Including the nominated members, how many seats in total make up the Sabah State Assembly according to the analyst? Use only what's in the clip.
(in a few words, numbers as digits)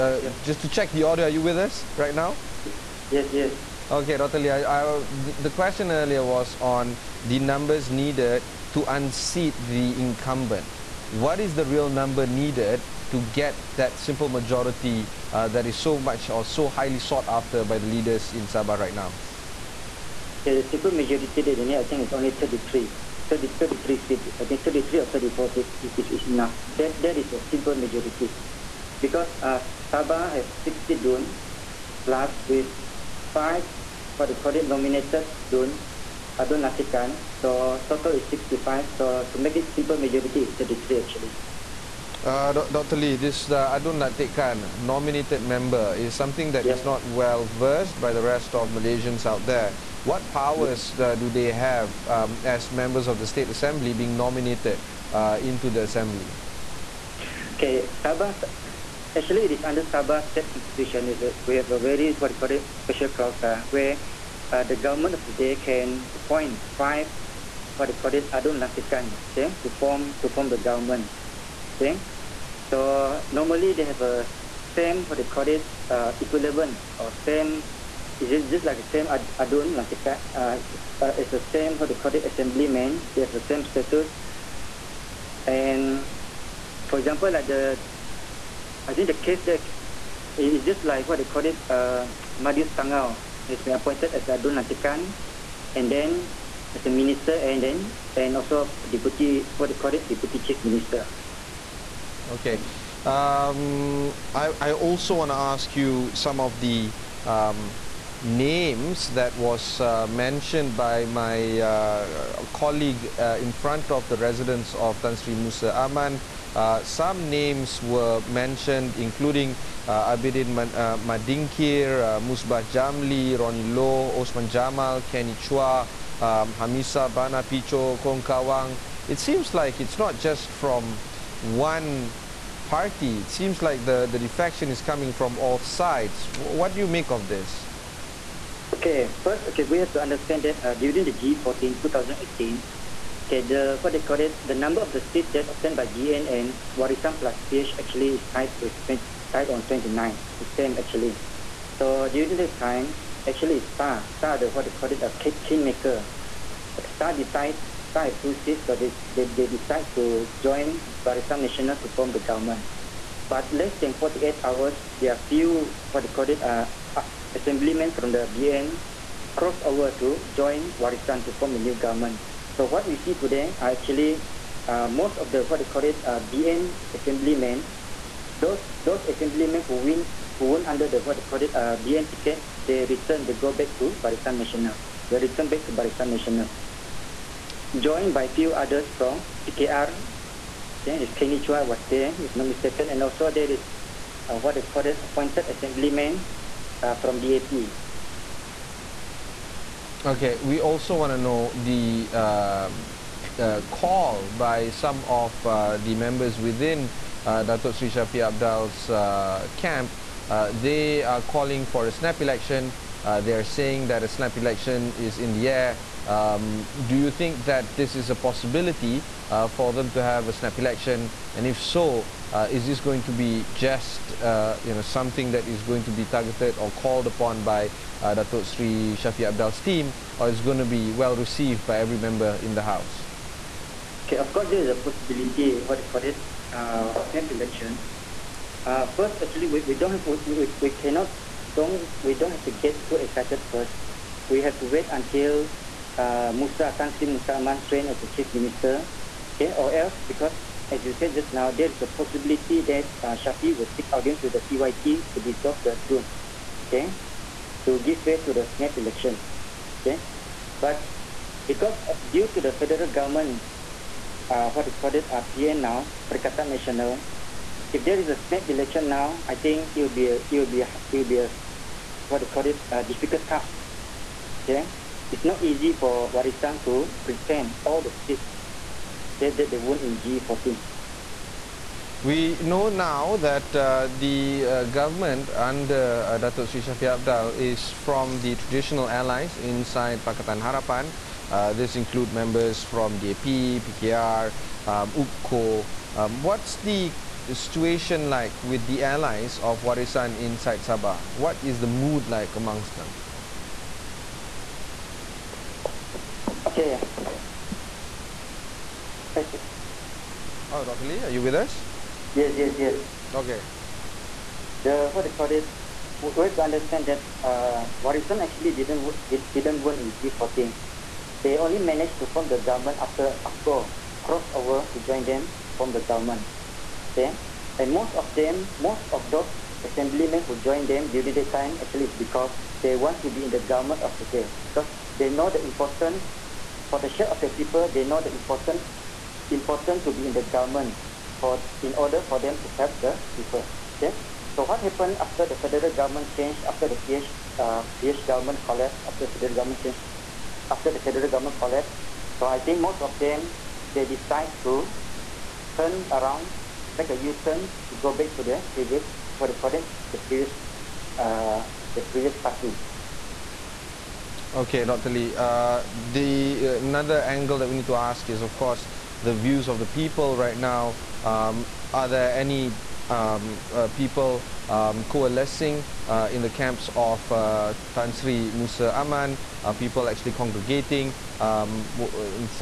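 65.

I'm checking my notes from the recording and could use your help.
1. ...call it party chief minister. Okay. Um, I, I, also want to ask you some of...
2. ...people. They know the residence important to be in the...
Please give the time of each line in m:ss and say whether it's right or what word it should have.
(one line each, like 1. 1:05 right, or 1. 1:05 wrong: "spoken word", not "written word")
1. 1:39 wrong: "deputy", not "party"
2. 5:37 wrong: "importance", not "residence".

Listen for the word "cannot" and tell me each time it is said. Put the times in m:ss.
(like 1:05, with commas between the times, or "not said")
4:00.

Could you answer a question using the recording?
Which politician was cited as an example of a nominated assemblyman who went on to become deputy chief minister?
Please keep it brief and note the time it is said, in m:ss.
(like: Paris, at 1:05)
Madius Tangau, at 1:32.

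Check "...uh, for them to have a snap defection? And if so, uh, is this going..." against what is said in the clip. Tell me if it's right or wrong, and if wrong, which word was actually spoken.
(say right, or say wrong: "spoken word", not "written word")
wrong: "election", not "defection".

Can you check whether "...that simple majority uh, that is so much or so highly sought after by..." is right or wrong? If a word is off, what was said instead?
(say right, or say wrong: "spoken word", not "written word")
right.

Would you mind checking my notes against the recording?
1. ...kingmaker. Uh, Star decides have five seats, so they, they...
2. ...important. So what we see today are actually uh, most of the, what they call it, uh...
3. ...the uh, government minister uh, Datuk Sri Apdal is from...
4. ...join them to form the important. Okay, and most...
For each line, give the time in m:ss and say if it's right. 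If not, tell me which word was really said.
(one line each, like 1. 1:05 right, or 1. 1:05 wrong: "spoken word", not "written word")
1. 2:35 wrong: "two", not "five"
2. 2:51 wrong: "government", not "important"
3. 4:43 wrong: "under", not "minister"
4. 5:24 wrong: "government", not "important".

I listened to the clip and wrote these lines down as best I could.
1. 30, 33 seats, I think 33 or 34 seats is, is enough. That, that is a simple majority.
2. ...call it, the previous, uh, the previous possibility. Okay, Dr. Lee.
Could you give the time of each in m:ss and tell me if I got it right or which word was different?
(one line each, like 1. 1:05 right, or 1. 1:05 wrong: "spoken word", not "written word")
1. 0:23 right
2. 5:59 wrong: "party", not "possibility".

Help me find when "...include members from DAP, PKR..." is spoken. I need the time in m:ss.
4:51.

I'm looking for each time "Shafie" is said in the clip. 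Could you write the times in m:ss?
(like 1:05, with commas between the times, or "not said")
3:27, 3:48, 4:13.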